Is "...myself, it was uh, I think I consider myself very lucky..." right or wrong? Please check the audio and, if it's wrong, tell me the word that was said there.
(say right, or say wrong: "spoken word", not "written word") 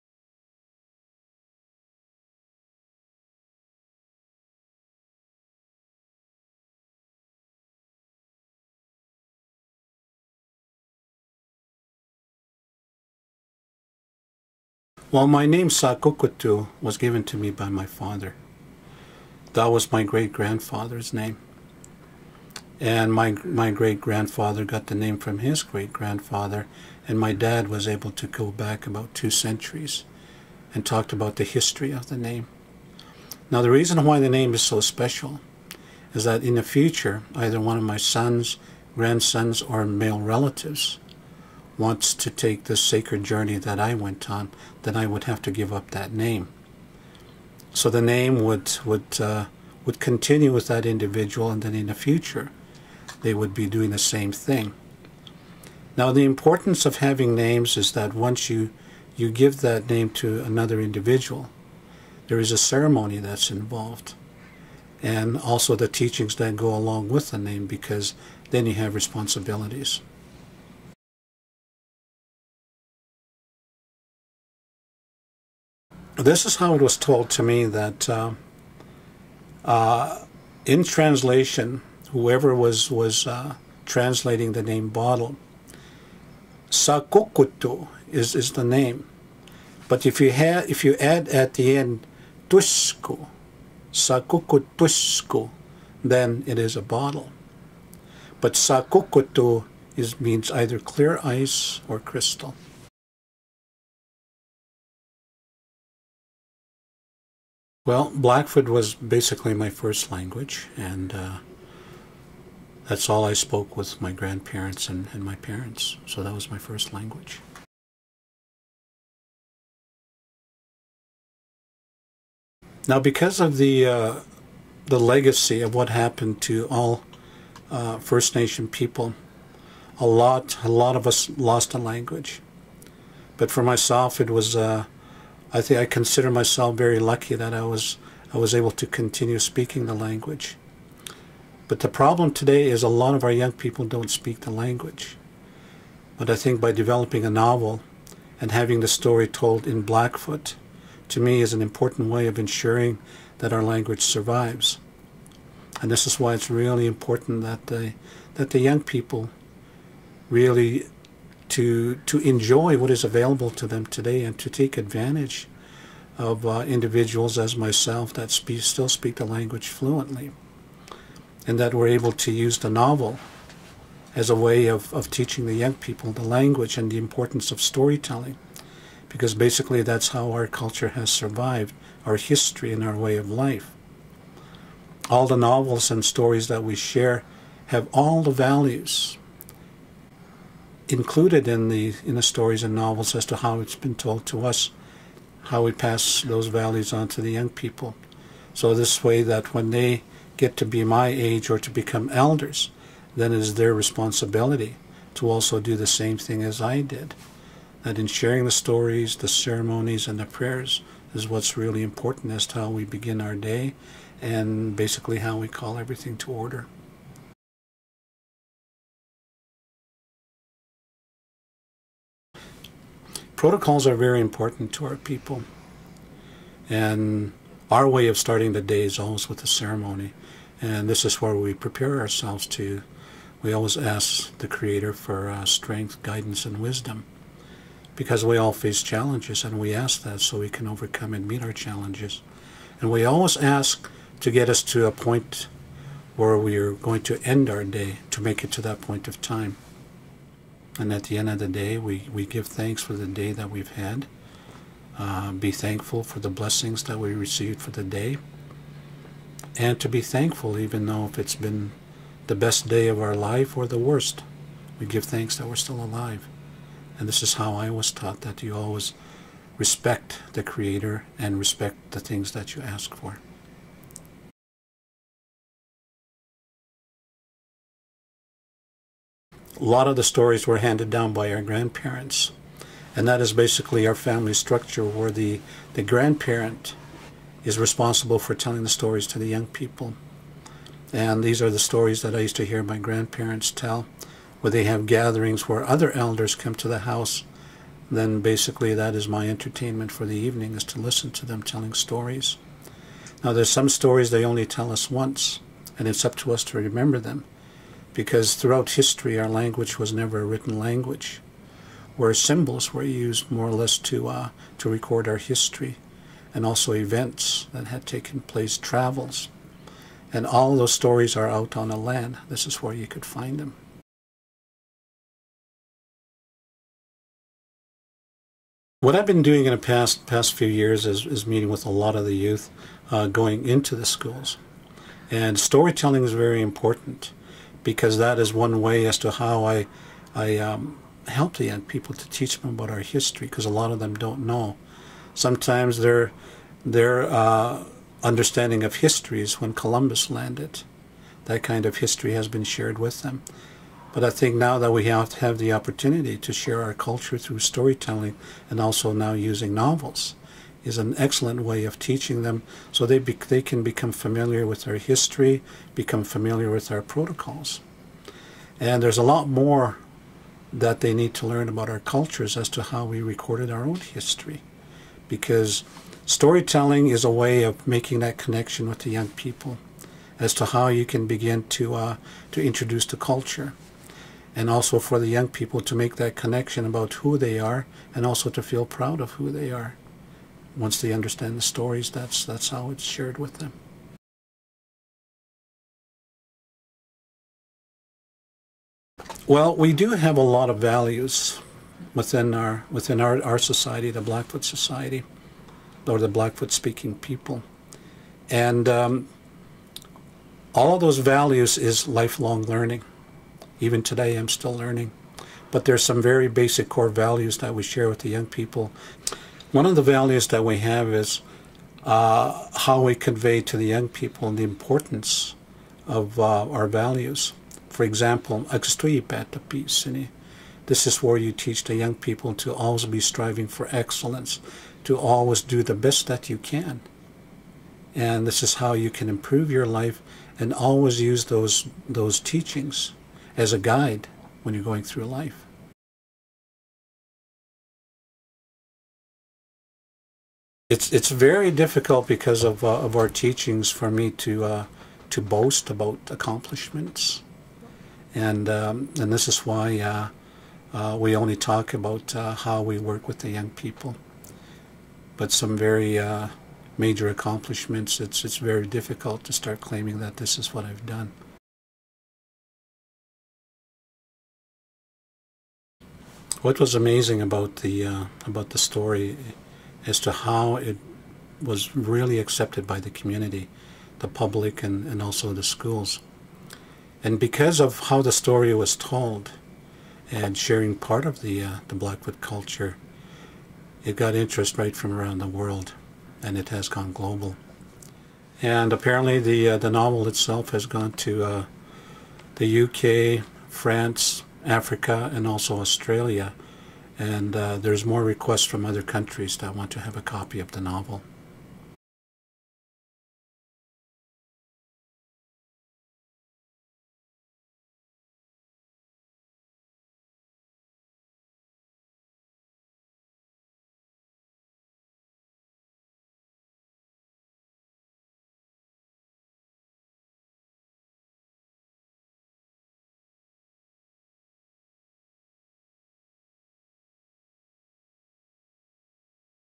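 right.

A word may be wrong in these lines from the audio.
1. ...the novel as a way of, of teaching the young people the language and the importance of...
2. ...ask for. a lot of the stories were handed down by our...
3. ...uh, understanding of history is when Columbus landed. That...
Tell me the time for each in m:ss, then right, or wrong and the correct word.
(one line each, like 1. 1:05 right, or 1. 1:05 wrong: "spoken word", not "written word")
1. 2:52 right
2. 4:32 right
3. 5:47 right.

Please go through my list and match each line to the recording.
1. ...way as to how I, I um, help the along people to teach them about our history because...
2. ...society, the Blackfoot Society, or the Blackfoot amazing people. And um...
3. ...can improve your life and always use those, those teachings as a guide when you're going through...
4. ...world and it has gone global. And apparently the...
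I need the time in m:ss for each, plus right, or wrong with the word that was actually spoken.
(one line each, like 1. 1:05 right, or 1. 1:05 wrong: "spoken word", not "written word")
1. 5:38 wrong: "young", not "along"
2. 6:43 wrong: "speaking", not "amazing"
3. 7:18 right
4. 8:15 right.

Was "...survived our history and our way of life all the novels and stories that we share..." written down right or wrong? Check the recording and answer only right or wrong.
right.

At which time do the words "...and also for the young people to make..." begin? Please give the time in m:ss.
6:24.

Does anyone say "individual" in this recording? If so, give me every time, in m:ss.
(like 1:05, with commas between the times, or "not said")
0:50, 1:00, 2:46.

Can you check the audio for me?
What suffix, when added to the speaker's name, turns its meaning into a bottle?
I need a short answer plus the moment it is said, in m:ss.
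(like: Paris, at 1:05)
tusku, at 1:32.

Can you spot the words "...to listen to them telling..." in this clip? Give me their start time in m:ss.
5:00.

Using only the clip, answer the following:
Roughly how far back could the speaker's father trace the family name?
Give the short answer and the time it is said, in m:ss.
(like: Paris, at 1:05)
about two centuries, at 0:28.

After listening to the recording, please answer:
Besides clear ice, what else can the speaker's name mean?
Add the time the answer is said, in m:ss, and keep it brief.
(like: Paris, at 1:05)
crystal, at 1:41.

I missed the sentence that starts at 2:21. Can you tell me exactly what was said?
But the problem today is a lot of our young people don't speak the language.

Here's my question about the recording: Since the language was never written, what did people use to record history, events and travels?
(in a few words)
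symbols.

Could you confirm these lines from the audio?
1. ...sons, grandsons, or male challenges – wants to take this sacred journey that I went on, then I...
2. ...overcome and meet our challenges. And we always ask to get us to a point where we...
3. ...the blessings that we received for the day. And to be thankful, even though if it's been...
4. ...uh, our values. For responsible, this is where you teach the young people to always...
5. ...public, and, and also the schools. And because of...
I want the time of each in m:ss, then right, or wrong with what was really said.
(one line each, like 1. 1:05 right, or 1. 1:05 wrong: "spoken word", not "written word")
1. 0:37 wrong: "relatives", not "challenges"
2. 4:00 right
3. 4:16 right
4. 7:06 wrong: "example", not "responsible"
5. 8:04 right.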